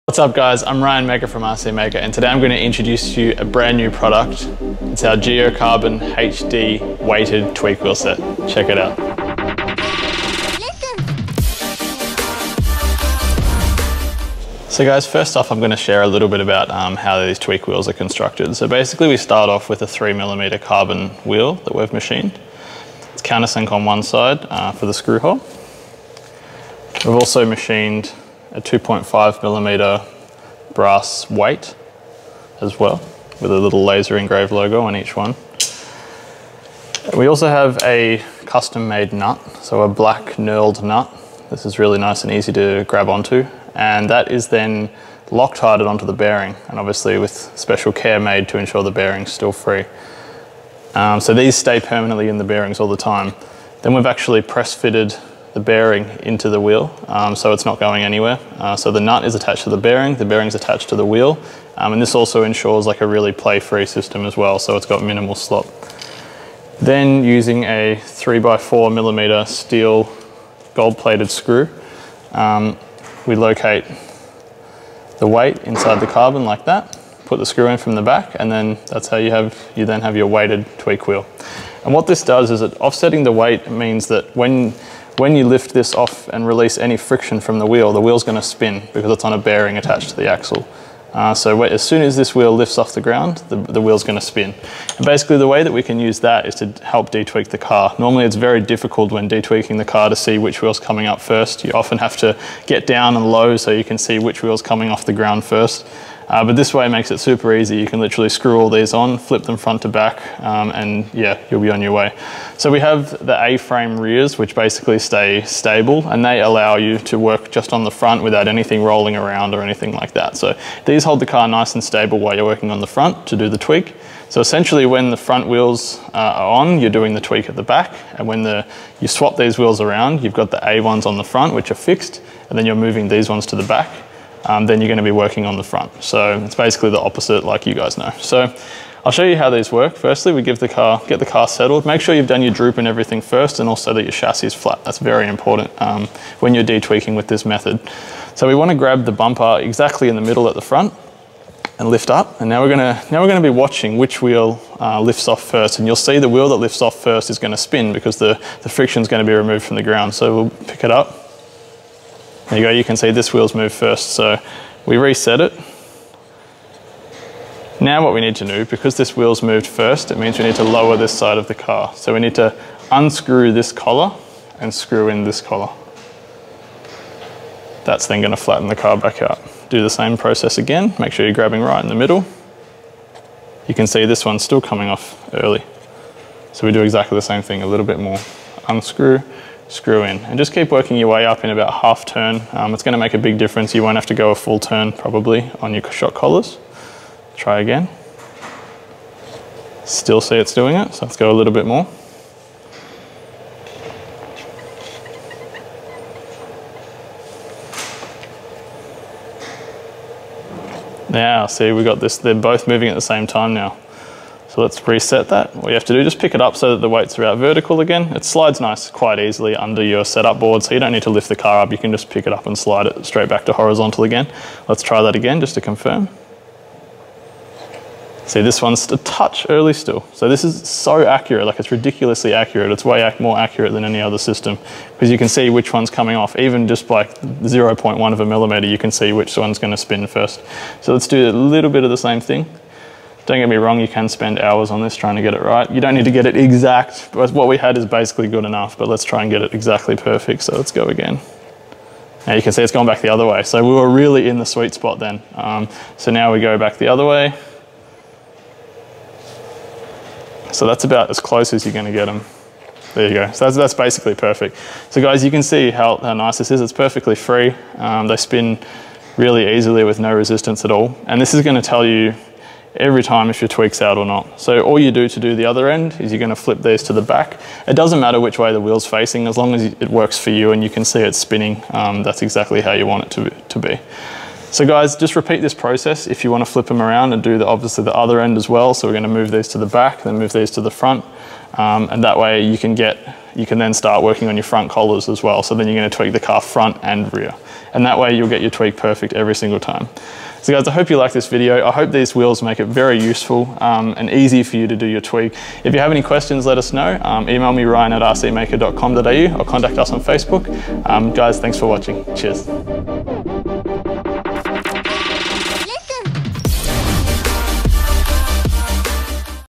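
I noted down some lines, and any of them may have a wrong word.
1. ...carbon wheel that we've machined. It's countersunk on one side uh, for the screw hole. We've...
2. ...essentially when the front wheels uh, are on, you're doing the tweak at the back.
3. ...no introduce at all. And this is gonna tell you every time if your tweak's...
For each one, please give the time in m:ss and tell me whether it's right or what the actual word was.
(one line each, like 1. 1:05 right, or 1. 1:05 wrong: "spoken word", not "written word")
1. 0:20 right
2. 2:04 right
3. 4:29 wrong: "resistance", not "introduce".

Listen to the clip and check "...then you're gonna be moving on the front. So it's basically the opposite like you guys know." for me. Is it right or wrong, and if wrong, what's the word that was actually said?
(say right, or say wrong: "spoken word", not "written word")
wrong: "working", not "moving".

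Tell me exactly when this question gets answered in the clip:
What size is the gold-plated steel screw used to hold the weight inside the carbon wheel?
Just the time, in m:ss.
1:08.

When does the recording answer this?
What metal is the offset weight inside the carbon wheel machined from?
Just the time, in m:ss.
0:30.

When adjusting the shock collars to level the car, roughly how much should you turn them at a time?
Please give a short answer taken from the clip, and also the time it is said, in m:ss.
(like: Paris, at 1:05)
Half turn, at 3:11.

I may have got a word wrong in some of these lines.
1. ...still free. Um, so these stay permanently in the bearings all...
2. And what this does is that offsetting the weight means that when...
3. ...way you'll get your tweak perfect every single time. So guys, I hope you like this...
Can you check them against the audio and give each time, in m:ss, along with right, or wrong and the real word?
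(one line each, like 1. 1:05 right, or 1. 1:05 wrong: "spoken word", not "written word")
1. 0:49 right
2. 1:21 right
3. 4:57 right.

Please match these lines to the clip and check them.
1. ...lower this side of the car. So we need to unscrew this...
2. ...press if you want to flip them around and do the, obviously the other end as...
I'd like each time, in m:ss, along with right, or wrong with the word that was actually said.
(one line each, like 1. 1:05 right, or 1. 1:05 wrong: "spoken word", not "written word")
1. 2:50 right
2. 4:45 wrong: "process", not "press".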